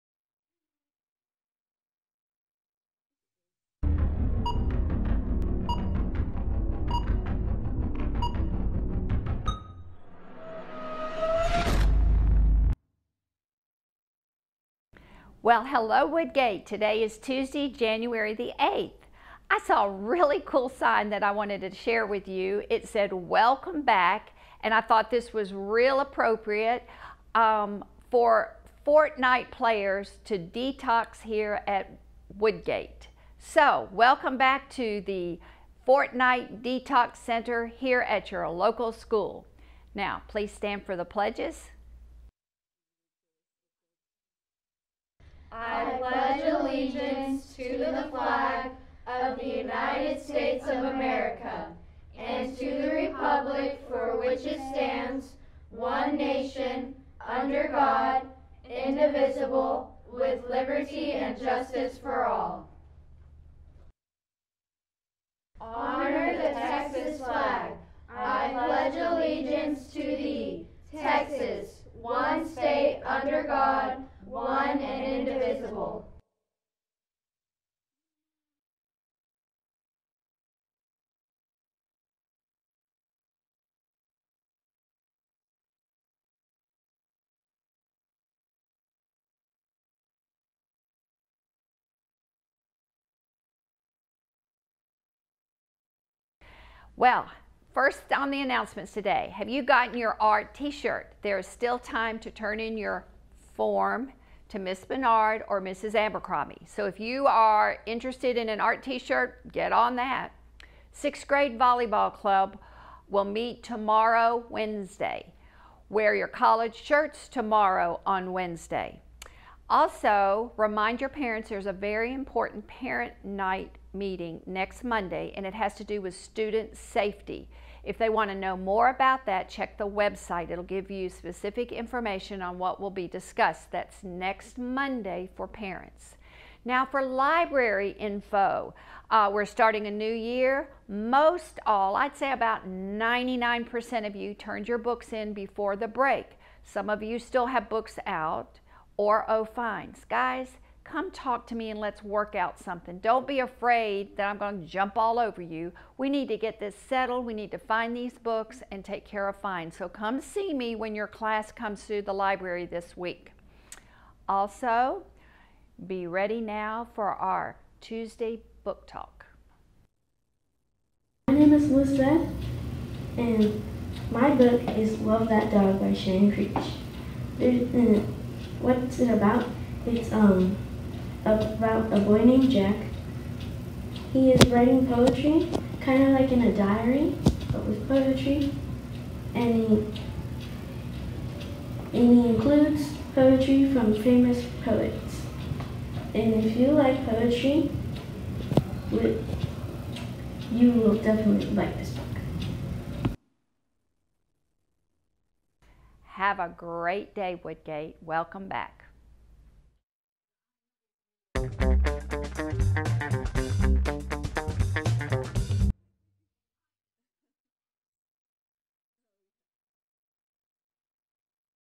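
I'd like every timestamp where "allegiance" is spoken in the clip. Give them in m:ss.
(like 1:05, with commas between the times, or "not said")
0:46, 1:08.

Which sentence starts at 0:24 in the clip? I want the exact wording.
And I thought this was real appropriate um, for Fortnite players to detox here at Woodgate.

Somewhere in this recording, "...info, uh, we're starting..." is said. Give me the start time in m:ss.
2:17.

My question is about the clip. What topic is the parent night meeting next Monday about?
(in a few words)
Student safety.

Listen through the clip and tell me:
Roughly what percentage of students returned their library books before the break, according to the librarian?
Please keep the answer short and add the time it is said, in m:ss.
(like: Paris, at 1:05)
99%, at 2:22.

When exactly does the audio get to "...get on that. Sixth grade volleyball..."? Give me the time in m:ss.
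1:49.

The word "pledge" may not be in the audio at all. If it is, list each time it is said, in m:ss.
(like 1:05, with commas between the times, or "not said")
0:41, 0:45, 1:08.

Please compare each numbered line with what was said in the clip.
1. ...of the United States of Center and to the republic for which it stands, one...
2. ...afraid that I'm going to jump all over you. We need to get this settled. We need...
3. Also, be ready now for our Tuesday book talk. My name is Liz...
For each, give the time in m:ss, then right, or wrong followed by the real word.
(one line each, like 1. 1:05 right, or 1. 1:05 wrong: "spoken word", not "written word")
1. 0:49 wrong: "America", not "Center"
2. 2:33 right
3. 2:44 right.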